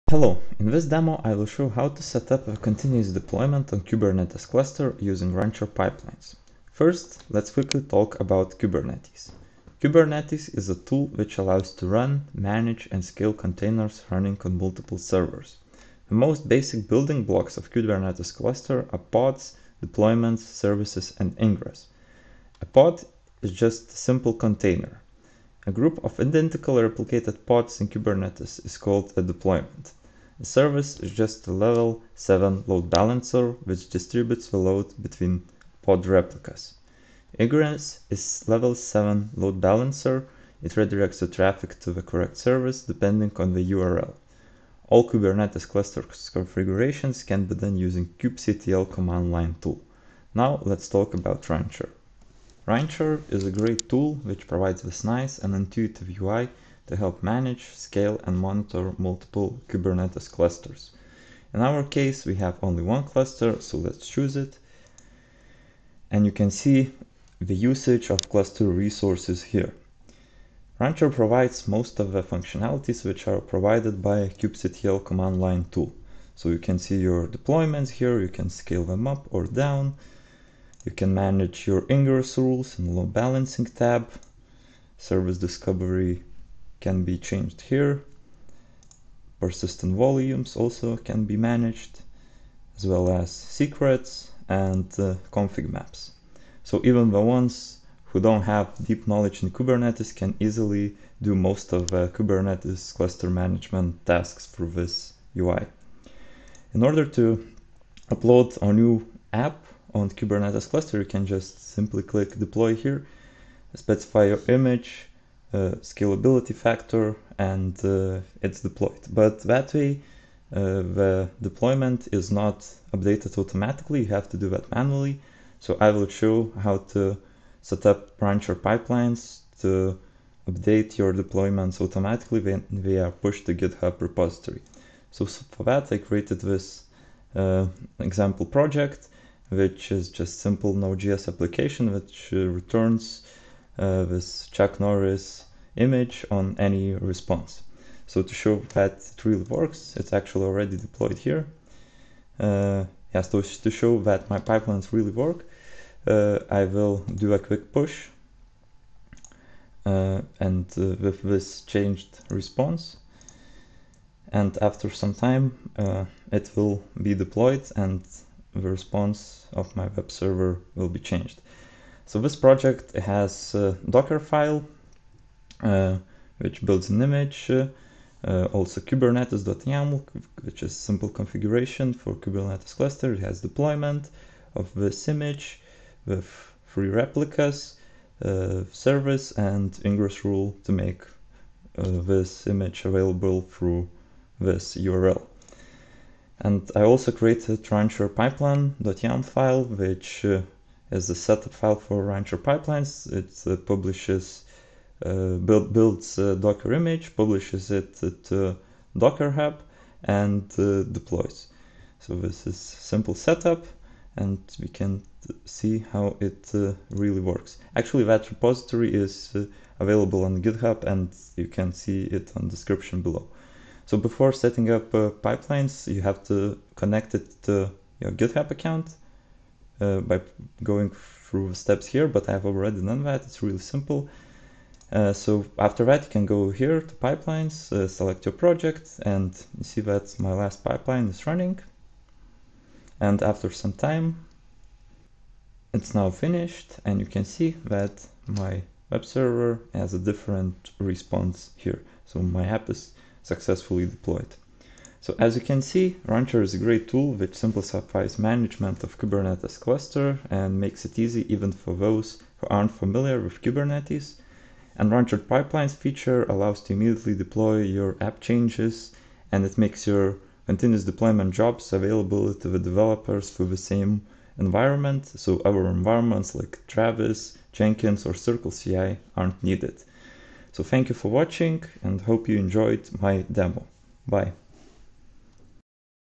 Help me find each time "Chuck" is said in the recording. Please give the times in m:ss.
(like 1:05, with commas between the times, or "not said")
2:24.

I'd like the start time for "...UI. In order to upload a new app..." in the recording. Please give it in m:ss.
1:45.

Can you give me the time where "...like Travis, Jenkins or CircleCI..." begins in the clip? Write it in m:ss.
4:36.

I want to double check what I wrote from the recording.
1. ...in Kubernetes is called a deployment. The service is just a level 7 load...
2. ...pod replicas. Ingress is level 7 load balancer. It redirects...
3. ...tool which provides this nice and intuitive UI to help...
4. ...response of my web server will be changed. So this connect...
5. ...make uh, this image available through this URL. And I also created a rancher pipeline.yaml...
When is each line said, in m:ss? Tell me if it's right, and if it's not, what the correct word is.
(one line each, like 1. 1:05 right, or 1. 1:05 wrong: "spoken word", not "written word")
1. 0:27 right
2. 0:35 right
3. 0:53 right
4. 2:48 wrong: "project", not "connect"
5. 3:10 right.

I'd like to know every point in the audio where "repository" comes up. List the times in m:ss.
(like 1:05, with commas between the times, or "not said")
2:13, 3:38.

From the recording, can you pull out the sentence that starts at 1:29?
Persistent volumes also can be managed as well as secrets and uh, config maps.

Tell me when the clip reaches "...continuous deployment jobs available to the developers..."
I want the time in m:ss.
4:30.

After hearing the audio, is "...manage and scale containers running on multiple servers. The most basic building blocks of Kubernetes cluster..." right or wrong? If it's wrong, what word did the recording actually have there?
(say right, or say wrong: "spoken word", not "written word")
right.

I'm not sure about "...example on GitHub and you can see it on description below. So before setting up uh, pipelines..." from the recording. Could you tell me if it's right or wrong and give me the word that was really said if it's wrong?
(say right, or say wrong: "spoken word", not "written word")
wrong: "available", not "example".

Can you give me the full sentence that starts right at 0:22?
A pod is just a simple container.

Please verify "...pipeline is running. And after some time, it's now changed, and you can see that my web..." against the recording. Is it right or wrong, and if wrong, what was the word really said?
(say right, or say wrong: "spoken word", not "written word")
wrong: "finished", not "changed".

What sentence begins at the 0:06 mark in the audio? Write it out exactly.
First, let's quickly talk about Kubernetes.